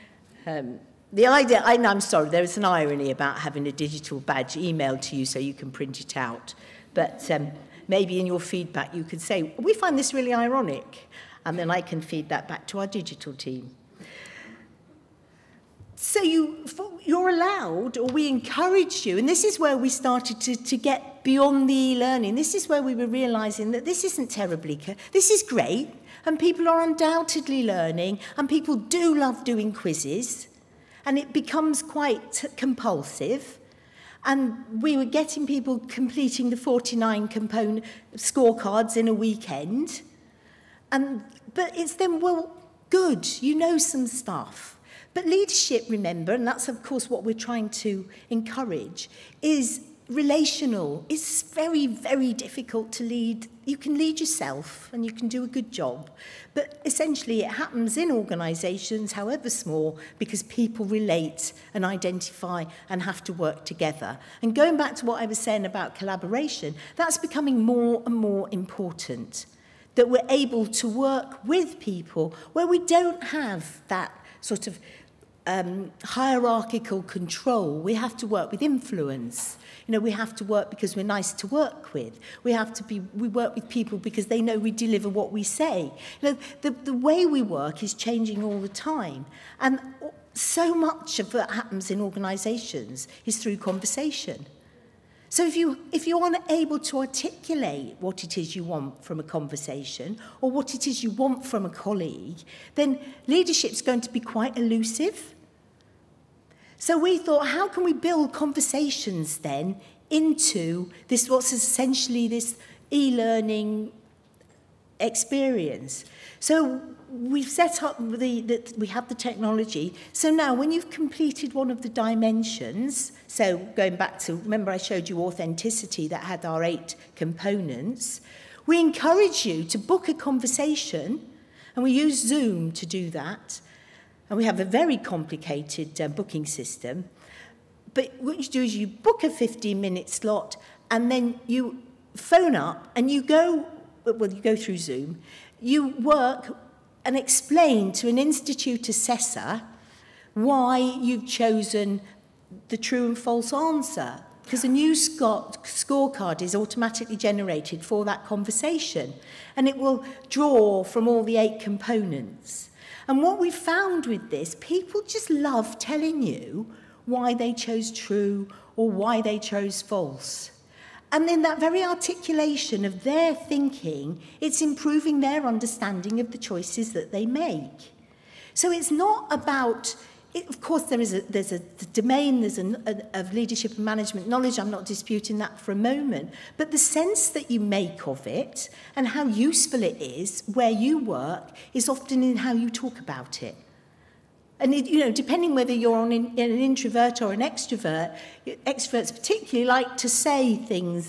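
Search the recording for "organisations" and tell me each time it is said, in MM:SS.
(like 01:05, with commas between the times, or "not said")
00:58, 01:31.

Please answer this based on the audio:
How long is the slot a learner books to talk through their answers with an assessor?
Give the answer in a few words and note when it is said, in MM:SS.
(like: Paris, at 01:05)
15 minutes, at 02:19.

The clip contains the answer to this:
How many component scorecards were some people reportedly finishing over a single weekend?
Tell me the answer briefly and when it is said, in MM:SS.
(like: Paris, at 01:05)
49, at 00:36.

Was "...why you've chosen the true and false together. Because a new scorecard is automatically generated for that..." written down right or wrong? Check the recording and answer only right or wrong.
wrong.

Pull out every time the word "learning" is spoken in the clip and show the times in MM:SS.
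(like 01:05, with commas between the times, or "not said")
00:21, 00:27, 01:52.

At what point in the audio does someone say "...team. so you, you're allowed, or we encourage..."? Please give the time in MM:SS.
00:13.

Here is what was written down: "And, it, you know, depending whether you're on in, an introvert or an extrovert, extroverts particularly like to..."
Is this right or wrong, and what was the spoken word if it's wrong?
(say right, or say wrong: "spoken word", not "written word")
right.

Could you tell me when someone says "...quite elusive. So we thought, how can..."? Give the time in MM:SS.
01:44.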